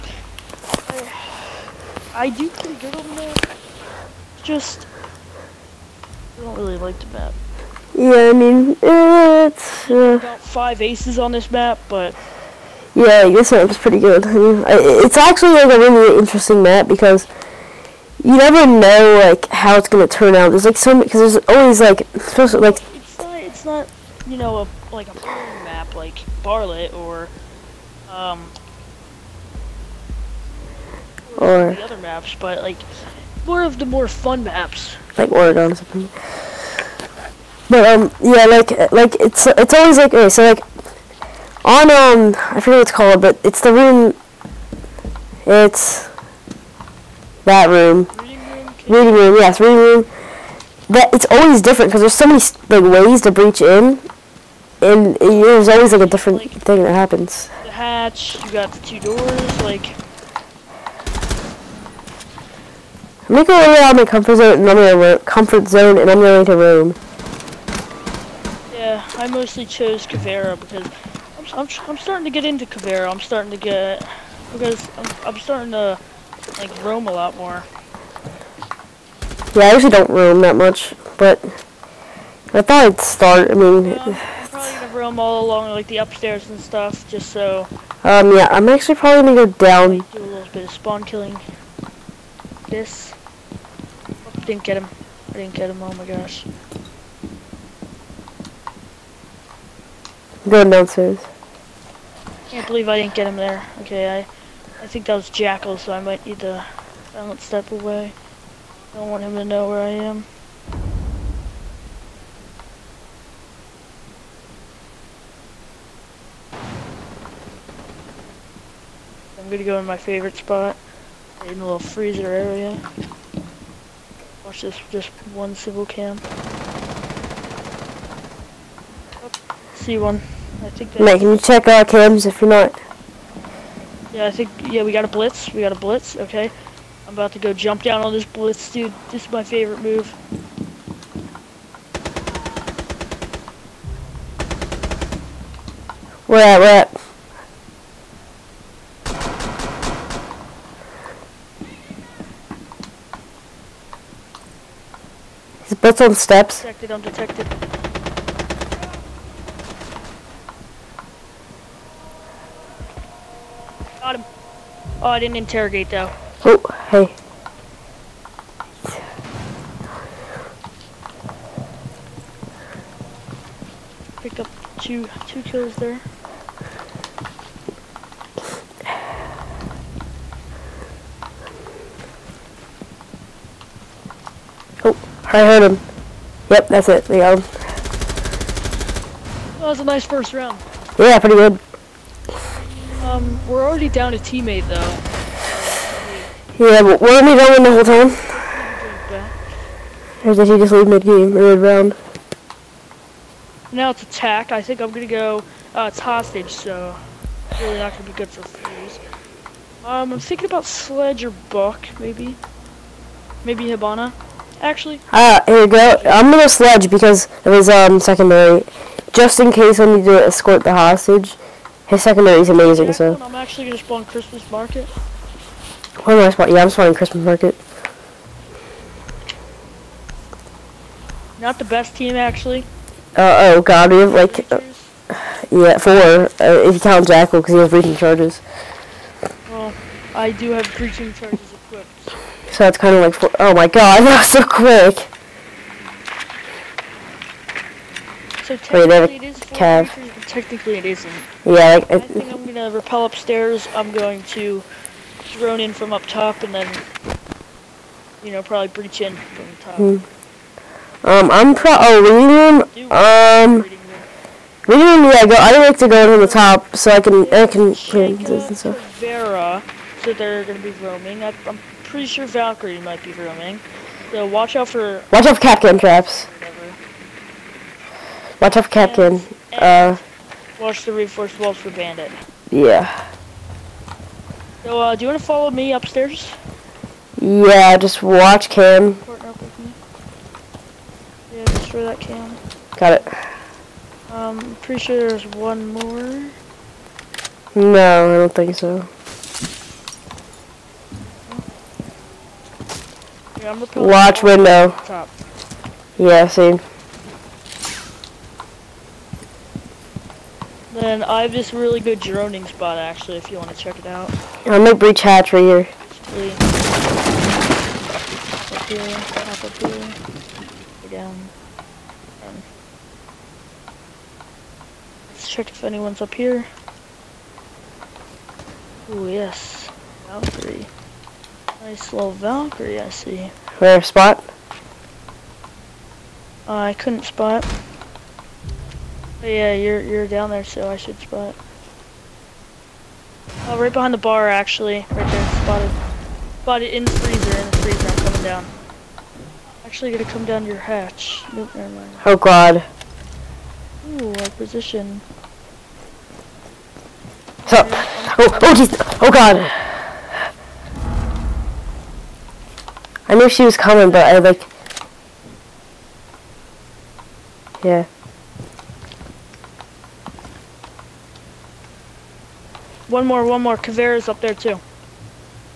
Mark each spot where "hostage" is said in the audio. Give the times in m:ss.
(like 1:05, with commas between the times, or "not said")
3:26, 3:40.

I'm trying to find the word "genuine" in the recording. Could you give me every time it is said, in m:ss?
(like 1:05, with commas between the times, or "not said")
not said.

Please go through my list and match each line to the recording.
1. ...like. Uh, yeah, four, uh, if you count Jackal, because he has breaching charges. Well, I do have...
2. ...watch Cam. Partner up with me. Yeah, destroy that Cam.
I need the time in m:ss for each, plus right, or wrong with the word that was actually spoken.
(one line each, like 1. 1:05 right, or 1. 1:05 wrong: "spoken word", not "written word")
1. 3:54 right
2. 4:48 right.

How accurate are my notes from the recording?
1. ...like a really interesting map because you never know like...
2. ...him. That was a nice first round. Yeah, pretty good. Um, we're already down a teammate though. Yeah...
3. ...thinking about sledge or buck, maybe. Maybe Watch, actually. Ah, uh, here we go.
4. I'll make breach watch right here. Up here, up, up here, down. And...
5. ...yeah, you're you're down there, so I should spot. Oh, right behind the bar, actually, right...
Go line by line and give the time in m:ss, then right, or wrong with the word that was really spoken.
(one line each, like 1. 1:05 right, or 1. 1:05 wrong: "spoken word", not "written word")
1. 0:15 right
2. 3:07 right
3. 3:30 wrong: "Hibana", not "Watch"
4. 5:14 wrong: "hatch", not "watch"
5. 5:39 right.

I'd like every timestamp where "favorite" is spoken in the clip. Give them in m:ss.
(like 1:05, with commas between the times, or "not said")
1:59, 2:19.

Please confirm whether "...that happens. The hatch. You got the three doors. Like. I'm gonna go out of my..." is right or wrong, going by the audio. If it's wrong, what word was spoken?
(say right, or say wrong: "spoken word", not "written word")
wrong: "two", not "three".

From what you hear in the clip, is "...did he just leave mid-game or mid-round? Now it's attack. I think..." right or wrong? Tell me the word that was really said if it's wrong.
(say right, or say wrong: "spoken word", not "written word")
right.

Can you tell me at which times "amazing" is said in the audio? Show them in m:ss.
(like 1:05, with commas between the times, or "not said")
3:42.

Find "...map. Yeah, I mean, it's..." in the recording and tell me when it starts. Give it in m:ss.
0:07.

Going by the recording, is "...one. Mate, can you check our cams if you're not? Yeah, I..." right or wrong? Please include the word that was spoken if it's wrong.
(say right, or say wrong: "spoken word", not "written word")
right.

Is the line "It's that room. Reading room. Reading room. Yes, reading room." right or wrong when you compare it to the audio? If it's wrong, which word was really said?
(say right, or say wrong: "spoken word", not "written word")
right.